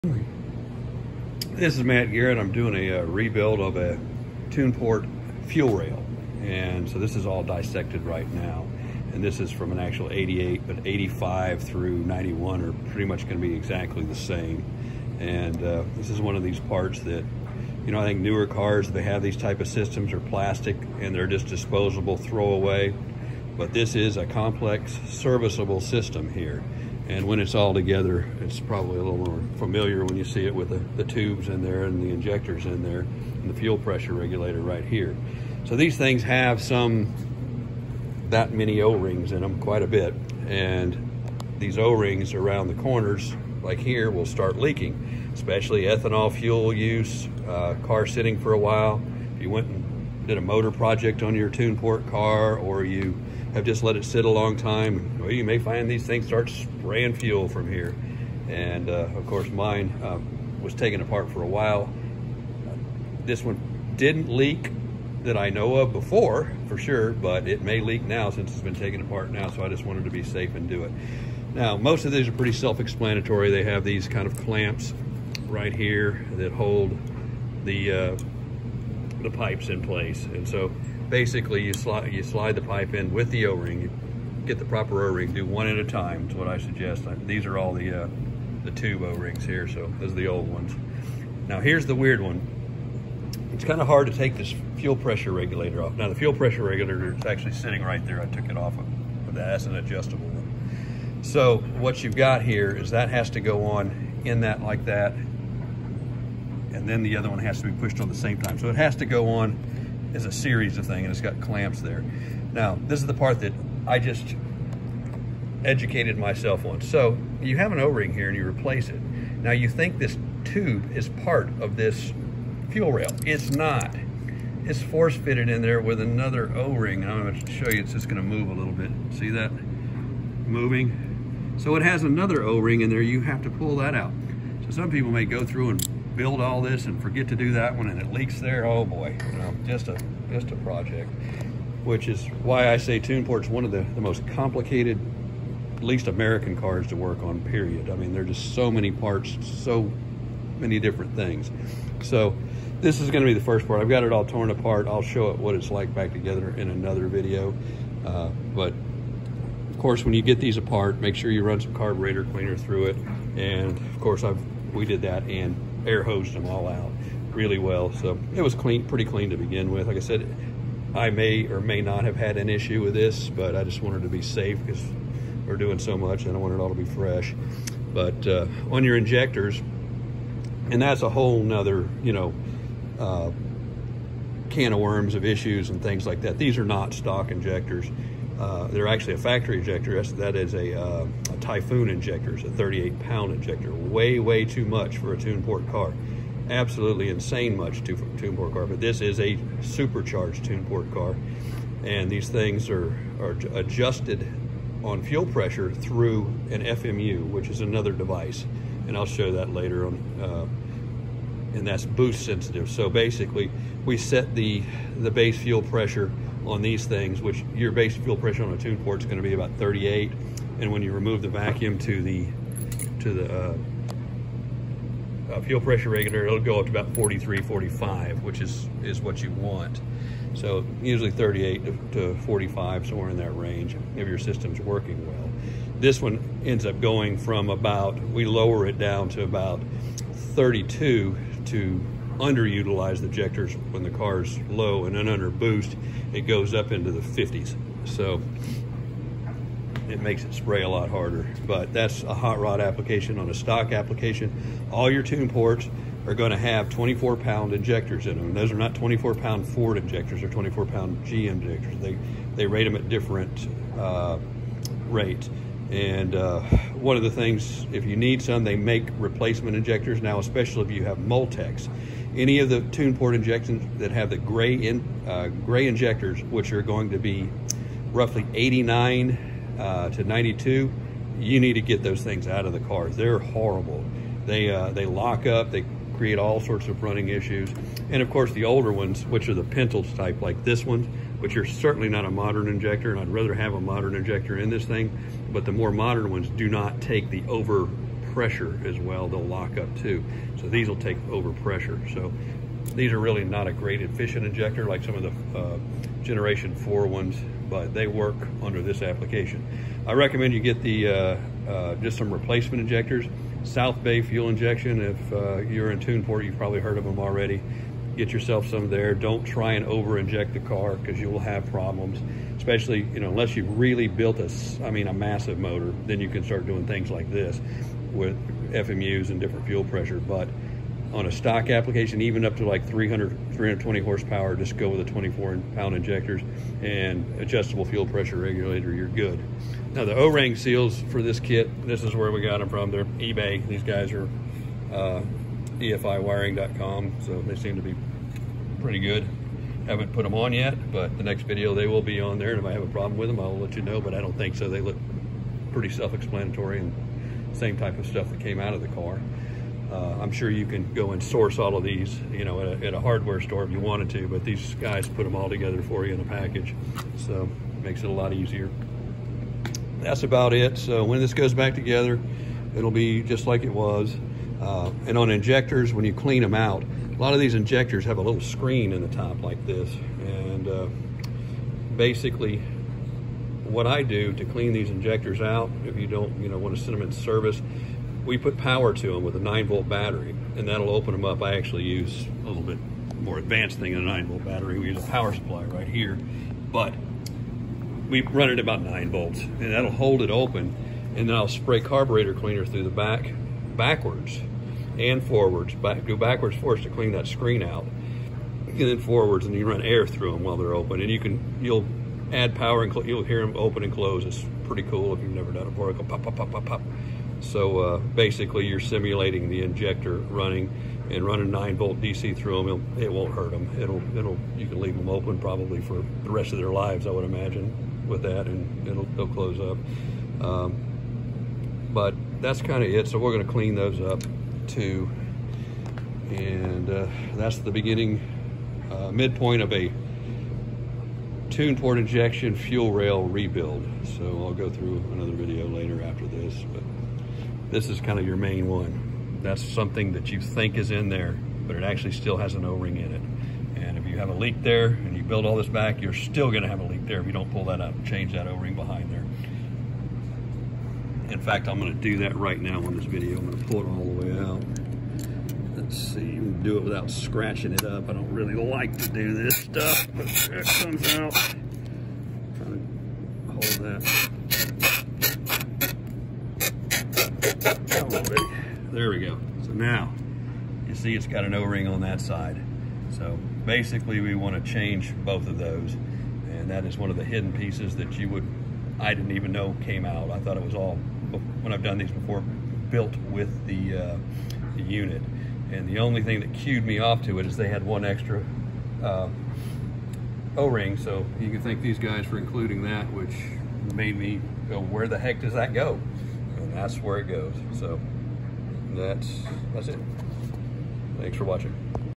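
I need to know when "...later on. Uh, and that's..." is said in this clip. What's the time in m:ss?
3:29.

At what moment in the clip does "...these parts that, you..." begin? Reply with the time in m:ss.
0:16.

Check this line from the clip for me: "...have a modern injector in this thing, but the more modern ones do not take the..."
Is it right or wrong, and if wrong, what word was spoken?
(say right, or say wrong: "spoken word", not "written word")
right.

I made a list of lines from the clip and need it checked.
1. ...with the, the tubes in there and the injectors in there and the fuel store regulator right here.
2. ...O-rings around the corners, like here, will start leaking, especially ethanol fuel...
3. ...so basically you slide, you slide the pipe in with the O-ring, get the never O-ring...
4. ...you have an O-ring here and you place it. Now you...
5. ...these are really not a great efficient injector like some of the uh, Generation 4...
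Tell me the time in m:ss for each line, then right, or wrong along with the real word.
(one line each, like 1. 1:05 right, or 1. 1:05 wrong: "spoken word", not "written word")
1. 0:30 wrong: "pressure", not "store"
2. 0:41 right
3. 1:20 wrong: "proper", not "never"
4. 1:57 wrong: "replace", not "place"
5. 5:02 right.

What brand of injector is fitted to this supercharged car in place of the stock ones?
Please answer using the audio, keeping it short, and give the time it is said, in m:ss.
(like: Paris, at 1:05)
Typhoon, at 3:11.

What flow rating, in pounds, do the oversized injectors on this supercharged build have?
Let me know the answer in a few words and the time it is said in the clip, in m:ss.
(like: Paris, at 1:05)
38 pound, at 3:12.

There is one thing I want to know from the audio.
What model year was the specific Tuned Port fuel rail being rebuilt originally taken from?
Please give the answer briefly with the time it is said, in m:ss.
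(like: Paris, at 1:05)
1988, at 0:10.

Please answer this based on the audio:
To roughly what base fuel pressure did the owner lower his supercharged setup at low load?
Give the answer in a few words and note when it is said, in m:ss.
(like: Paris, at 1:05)
32, at 4:00.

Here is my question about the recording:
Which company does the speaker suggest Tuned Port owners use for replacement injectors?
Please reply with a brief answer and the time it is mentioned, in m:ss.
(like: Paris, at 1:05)
South Bay Fuel Injection, at 5:13.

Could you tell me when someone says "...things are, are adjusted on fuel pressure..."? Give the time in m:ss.
3:22.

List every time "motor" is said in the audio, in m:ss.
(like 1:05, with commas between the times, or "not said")
0:50, 5:25.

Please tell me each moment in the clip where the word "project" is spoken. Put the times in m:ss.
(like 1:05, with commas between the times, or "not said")
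0:50, 2:20.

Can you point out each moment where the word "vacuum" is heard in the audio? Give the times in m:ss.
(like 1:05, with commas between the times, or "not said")
3:41.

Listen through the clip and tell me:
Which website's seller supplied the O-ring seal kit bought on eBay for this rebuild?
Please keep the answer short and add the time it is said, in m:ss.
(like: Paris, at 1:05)
EFIwiring.com, at 5:45.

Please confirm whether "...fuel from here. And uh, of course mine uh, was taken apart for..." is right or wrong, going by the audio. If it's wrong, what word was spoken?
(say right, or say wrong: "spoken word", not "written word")
right.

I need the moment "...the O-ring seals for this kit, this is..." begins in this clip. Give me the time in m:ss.
5:39.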